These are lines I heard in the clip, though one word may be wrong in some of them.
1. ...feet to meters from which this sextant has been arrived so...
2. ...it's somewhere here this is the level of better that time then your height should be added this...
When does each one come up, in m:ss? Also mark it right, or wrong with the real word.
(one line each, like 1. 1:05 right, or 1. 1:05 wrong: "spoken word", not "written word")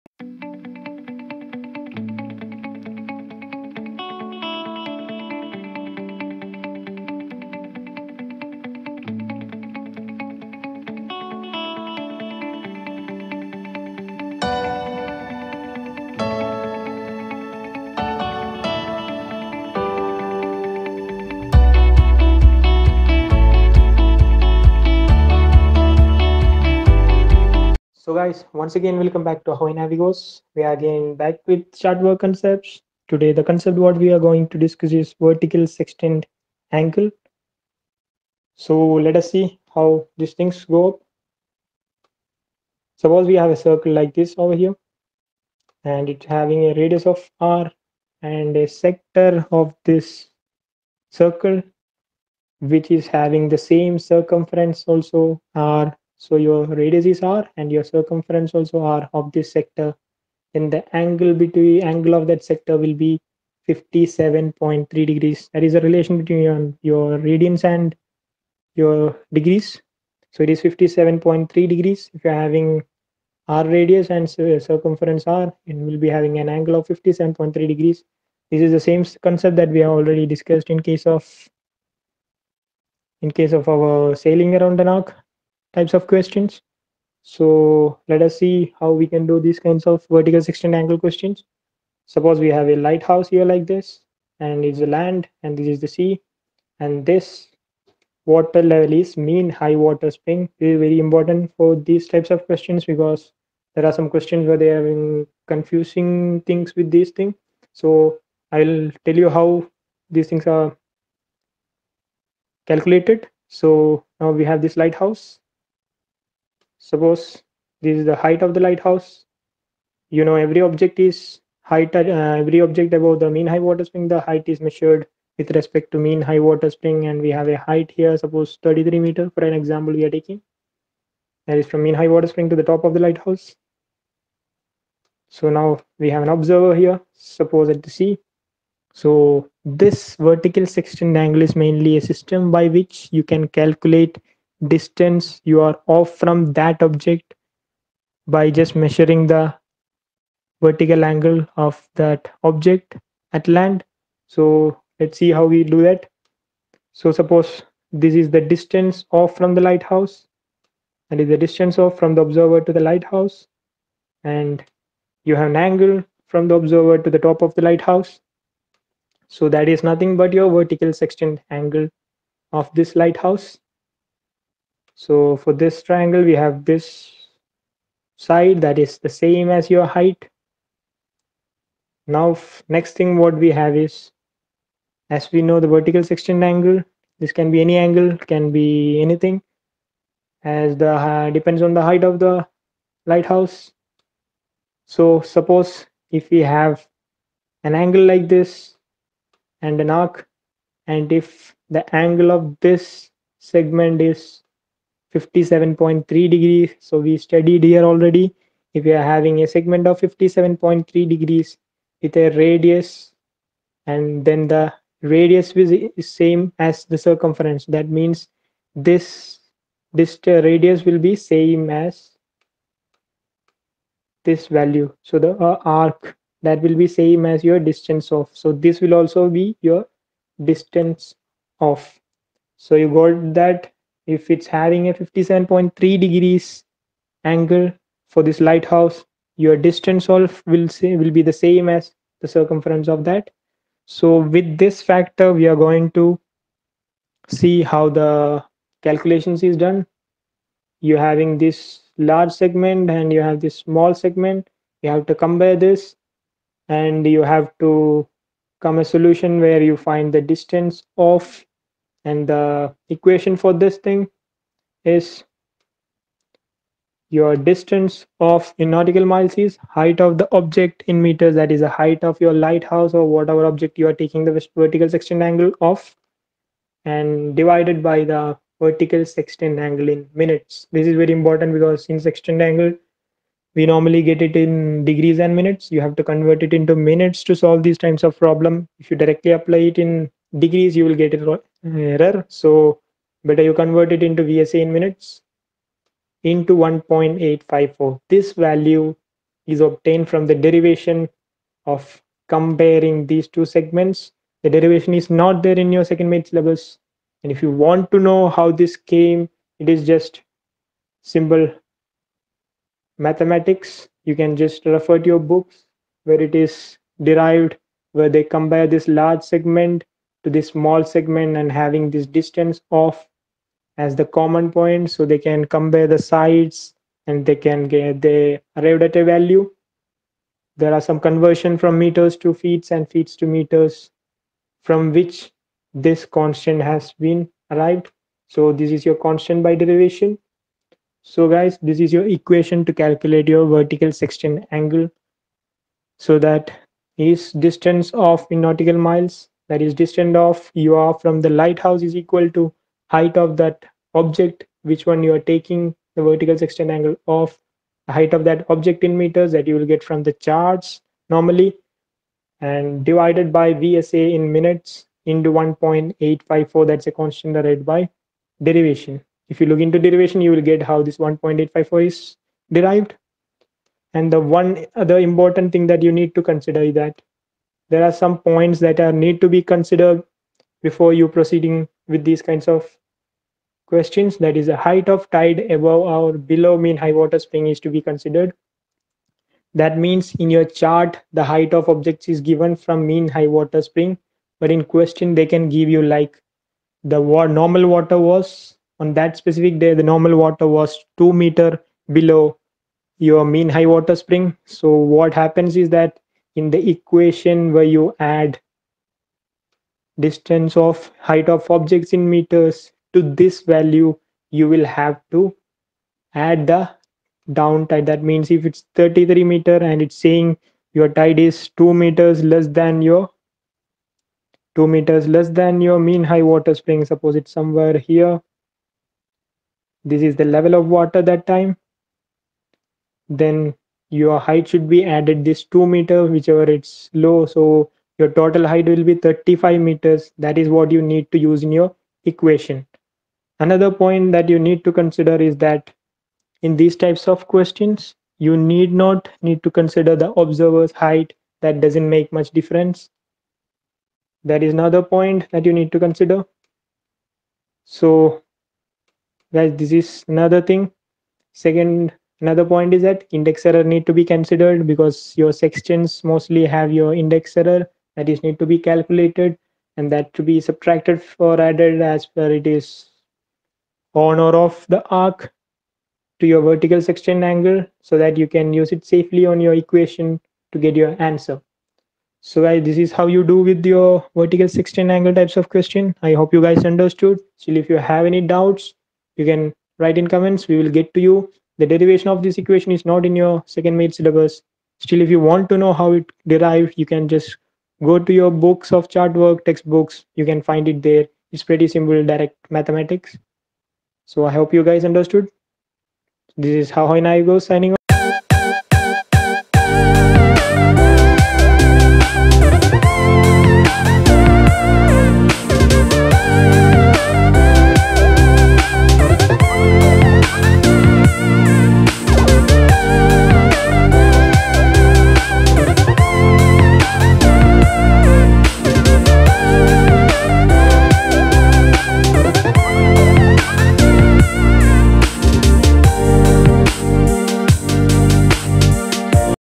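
1. 5:32 wrong: "constant", not "sextant"
2. 7:07 wrong: "water", not "better".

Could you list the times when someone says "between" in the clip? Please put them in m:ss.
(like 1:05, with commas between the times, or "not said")
1:01, 1:06.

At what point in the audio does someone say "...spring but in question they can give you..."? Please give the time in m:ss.
6:33.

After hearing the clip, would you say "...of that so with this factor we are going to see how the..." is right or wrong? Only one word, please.
right.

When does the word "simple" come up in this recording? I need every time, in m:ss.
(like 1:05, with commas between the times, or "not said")
5:11, 8:21.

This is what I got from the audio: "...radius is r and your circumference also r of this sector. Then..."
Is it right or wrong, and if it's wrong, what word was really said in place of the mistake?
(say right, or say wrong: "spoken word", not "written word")
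right.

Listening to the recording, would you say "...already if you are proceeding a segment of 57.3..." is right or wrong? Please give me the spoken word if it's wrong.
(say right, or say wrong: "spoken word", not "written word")
wrong: "having", not "proceeding".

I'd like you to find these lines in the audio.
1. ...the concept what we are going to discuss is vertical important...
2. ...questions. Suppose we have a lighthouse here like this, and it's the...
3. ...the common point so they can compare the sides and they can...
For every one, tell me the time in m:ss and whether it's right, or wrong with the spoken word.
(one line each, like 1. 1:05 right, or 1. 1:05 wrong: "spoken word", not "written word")
1. 0:33 wrong: "sextant", not "important"
2. 1:30 right
3. 5:23 right.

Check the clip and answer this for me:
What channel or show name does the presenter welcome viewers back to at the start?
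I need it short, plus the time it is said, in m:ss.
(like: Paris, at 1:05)
Ahoy Navigos, at 0:29.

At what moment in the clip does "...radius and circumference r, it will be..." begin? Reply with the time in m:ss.
1:13.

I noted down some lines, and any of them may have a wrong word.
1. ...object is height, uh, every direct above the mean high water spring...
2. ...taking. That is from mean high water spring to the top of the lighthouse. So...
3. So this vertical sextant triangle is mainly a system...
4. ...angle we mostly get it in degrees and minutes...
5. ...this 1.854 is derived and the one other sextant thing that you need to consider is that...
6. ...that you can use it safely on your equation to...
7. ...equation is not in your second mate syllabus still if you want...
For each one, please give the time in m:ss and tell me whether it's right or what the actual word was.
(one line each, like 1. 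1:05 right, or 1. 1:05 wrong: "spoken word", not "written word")
1. 2:00 wrong: "object", not "direct"
2. 2:10 right
3. 2:18 wrong: "angle", not "triangle"
4. 4:42 wrong: "normally", not "mostly"
5. 6:10 wrong: "important", not "sextant"
6. 7:57 right
7. 8:12 right.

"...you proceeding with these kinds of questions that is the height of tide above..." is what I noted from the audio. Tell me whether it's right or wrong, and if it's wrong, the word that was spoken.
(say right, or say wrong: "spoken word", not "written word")
right.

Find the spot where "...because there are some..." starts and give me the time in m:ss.
1:42.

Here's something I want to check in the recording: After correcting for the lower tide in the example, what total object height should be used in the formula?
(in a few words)
35 meters.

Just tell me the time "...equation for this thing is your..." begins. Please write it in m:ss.
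4:22.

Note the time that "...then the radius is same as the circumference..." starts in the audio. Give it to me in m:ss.
3:34.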